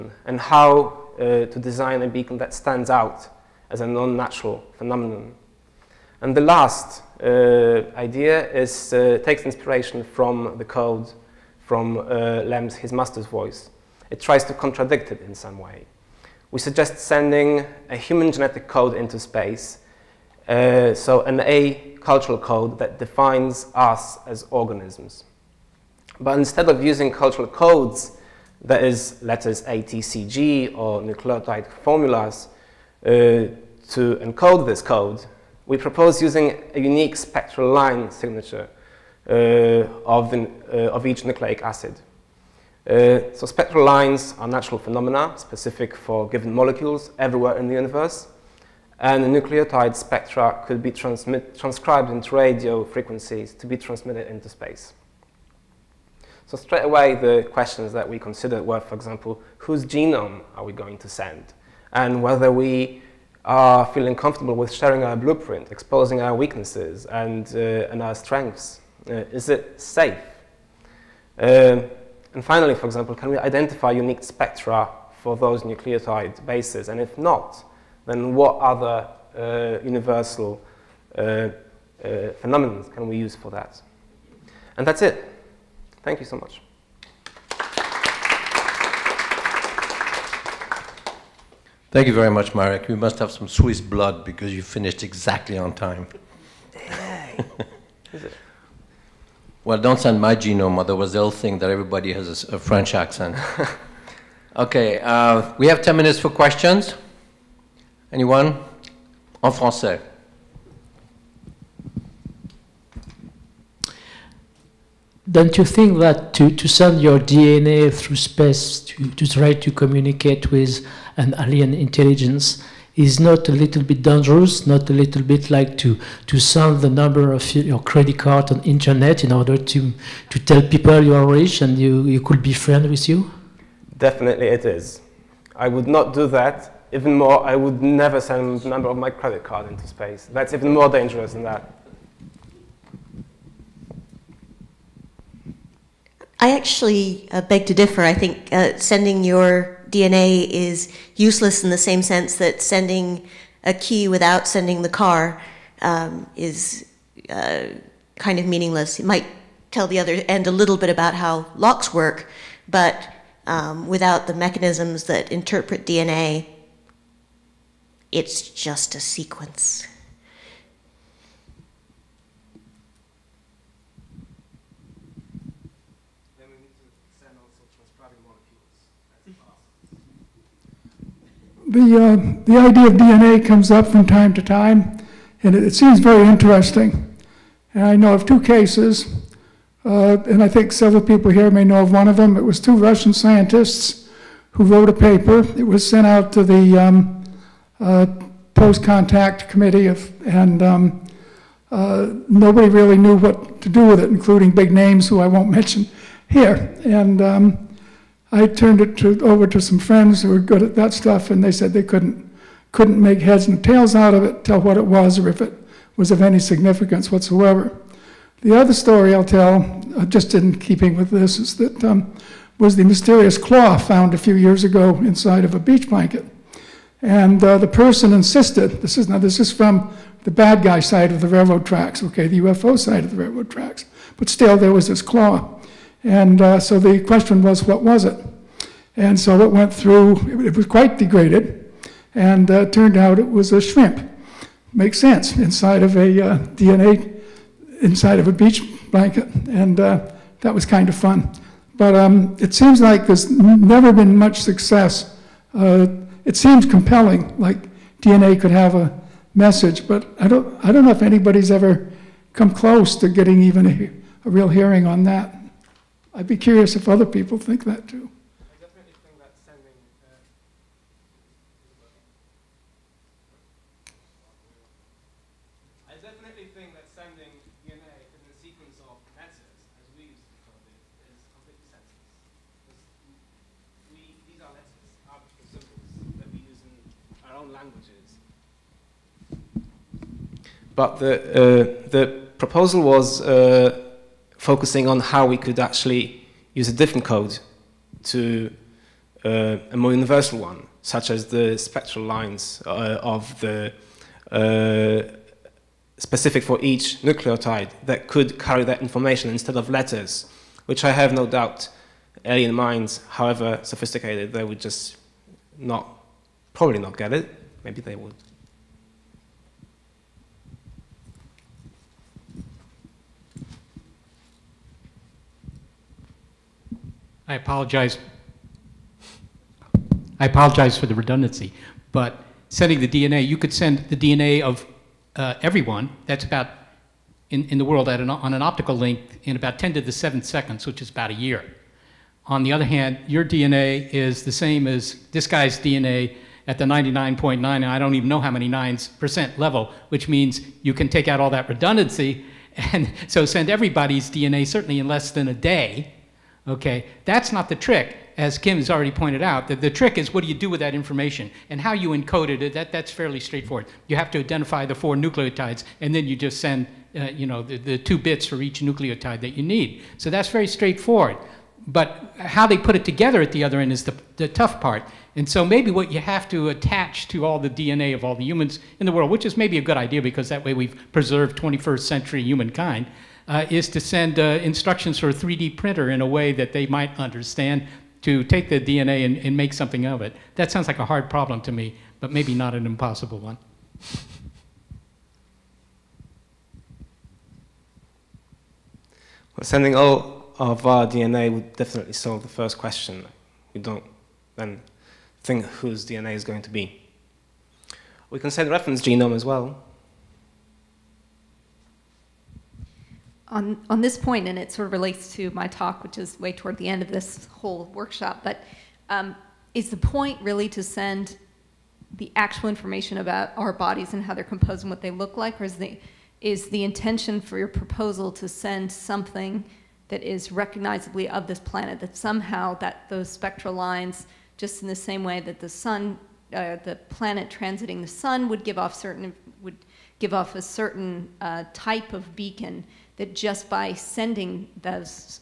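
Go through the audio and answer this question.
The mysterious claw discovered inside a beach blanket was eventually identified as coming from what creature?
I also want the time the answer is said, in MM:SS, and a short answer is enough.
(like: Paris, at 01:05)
A shrimp, at 04:03.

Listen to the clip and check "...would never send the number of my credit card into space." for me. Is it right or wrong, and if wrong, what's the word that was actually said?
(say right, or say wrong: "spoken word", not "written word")
right.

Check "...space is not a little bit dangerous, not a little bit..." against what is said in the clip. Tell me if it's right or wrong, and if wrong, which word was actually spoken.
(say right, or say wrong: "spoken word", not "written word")
wrong: "intelligence", not "space".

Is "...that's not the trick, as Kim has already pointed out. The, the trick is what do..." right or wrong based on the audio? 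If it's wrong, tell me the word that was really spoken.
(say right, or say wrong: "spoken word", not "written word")
right.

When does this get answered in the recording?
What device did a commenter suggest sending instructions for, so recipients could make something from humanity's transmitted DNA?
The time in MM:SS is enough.
06:25.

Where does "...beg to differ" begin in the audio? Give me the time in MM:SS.
02:27.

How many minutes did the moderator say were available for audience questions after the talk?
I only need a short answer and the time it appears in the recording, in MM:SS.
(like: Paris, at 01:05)
10, at 01:45.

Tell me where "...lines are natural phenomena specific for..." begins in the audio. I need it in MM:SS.
00:43.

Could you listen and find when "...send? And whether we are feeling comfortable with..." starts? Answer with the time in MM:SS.
01:01.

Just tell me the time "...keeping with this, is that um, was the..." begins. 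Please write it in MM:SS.
03:40.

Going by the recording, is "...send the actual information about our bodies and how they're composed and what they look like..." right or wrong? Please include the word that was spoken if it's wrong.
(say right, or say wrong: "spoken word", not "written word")
right.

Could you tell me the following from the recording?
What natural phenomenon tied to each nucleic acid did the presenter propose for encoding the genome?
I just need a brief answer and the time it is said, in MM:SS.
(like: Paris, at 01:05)
Spectral line signature, at 00:37.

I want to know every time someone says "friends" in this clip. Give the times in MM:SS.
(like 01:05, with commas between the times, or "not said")
02:12, 03:29.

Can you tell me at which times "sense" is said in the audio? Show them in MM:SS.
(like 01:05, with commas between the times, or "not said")
02:32, 04:04.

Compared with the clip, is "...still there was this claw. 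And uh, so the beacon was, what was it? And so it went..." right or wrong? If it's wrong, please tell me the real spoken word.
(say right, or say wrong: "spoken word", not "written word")
wrong: "question", not "beacon".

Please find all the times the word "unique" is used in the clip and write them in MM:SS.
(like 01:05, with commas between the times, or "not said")
00:36, 01:13.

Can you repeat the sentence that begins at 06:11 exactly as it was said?
But how they put it together at the other end is the, the tough part.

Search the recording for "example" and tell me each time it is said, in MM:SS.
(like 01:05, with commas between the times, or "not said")
00:58, 01:12.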